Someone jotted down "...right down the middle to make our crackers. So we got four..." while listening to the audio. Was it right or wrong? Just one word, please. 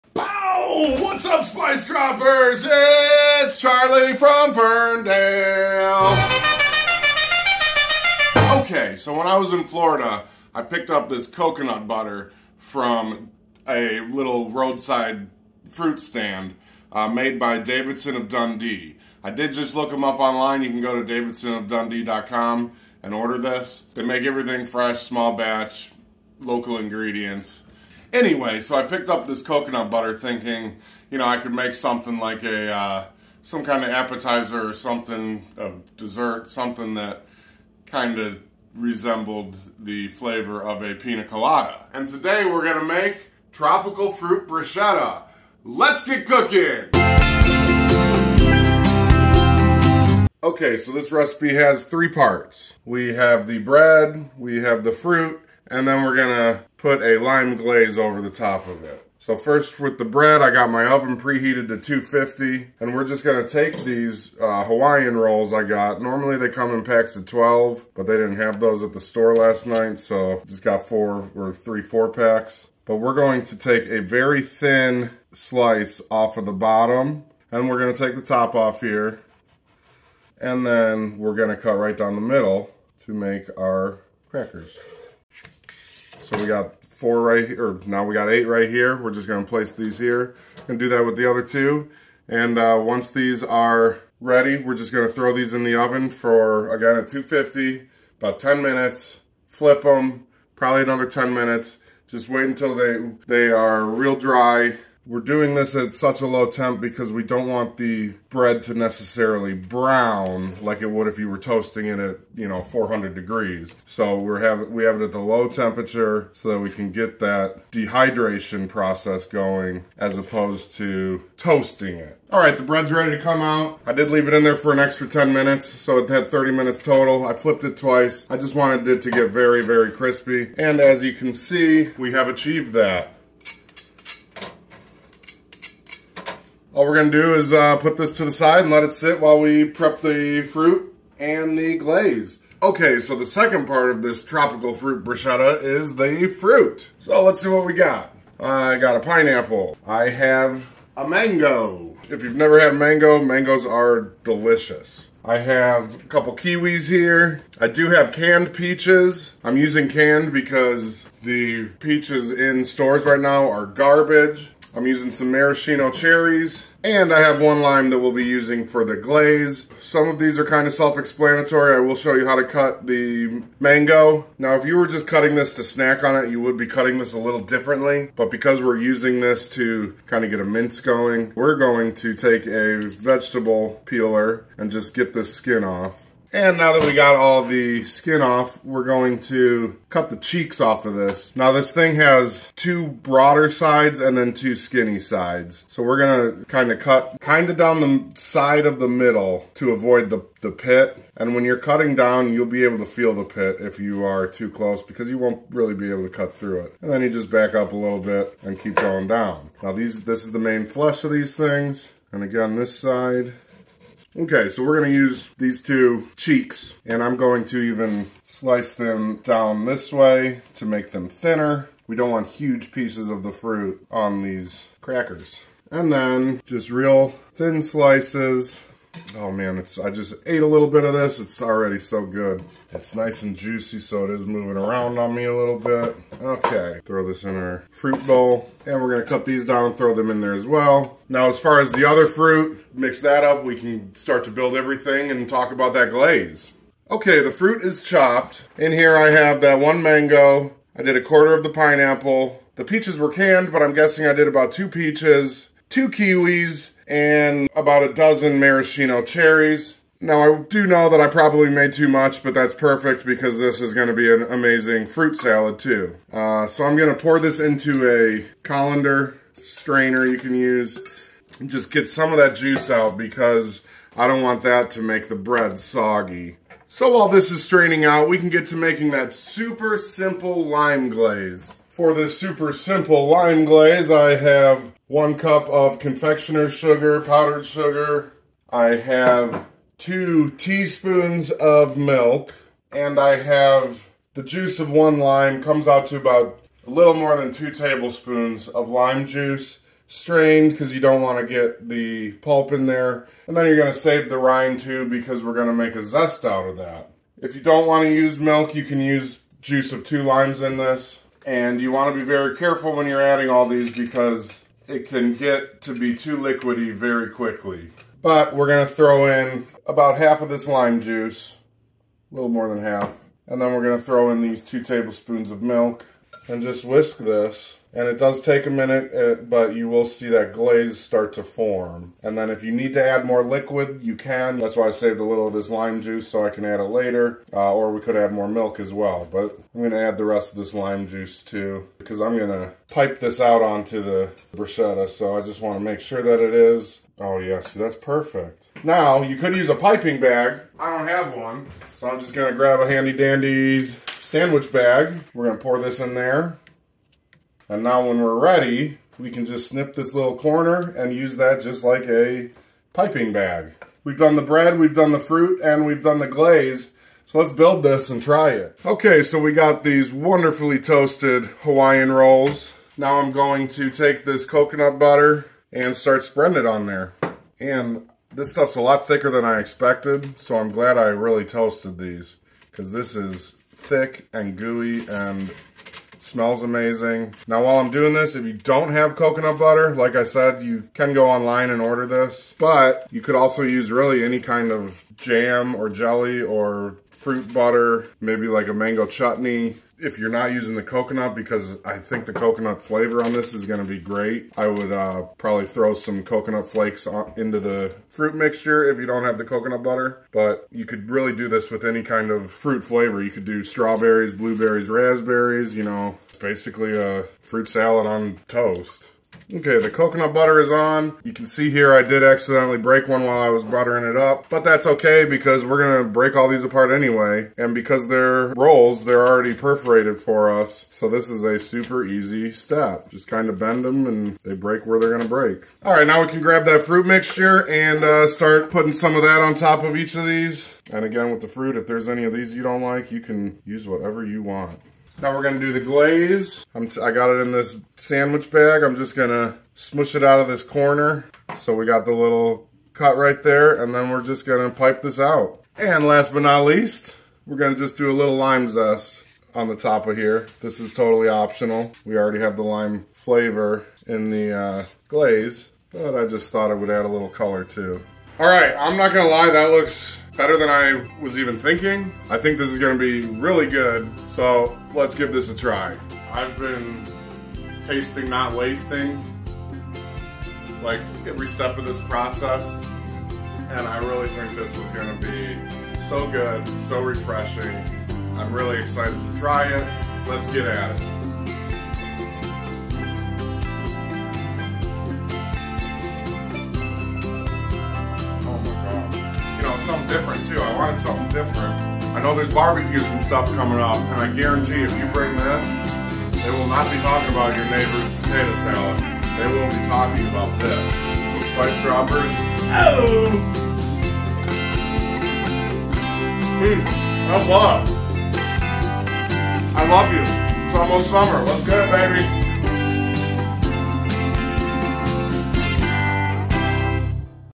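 right.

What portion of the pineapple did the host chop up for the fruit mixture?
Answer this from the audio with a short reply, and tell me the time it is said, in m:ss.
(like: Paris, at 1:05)
a quarter, at 4:10.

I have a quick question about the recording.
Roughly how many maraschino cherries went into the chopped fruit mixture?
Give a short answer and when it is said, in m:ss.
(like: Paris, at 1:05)
a dozen, at 4:17.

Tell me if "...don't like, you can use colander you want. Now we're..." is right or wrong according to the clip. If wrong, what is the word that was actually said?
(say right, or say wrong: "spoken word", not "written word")
wrong: "whatever", not "colander".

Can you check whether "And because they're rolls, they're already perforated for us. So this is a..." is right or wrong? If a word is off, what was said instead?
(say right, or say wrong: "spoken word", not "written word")
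right.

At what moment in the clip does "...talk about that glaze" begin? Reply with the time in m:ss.
4:05.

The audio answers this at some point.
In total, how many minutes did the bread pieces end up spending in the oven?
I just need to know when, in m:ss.
2:06.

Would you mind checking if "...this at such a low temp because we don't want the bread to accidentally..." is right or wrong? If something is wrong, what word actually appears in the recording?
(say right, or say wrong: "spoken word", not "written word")
wrong: "necessarily", not "accidentally".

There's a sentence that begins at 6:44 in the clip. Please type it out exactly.
I would uh, probably throw some coconut flakes on, into the fruit mixture if you don't have the coconut butter.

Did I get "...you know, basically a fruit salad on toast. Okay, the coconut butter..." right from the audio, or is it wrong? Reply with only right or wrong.
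right.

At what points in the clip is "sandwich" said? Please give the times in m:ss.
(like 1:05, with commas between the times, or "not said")
5:53, 7:27.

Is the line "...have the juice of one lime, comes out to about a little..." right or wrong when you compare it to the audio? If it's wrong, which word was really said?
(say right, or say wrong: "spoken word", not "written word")
right.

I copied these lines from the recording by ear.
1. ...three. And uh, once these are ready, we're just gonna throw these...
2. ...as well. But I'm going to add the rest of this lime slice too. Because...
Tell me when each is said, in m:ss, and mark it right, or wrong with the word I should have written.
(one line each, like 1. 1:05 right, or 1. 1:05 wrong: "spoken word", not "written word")
1. 1:31 wrong: "two", not "three"
2. 5:38 wrong: "juice", not "slice".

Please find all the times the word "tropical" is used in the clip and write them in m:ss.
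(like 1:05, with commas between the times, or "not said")
0:43, 2:24.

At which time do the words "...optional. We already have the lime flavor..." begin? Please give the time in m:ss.
7:41.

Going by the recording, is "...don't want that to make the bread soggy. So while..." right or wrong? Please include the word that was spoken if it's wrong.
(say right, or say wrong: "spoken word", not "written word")
right.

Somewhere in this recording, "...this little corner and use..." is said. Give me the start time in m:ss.
5:59.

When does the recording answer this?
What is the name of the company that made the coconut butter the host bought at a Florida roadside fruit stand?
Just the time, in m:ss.
0:17.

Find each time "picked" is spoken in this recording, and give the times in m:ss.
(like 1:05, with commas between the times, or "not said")
0:10, 0:28.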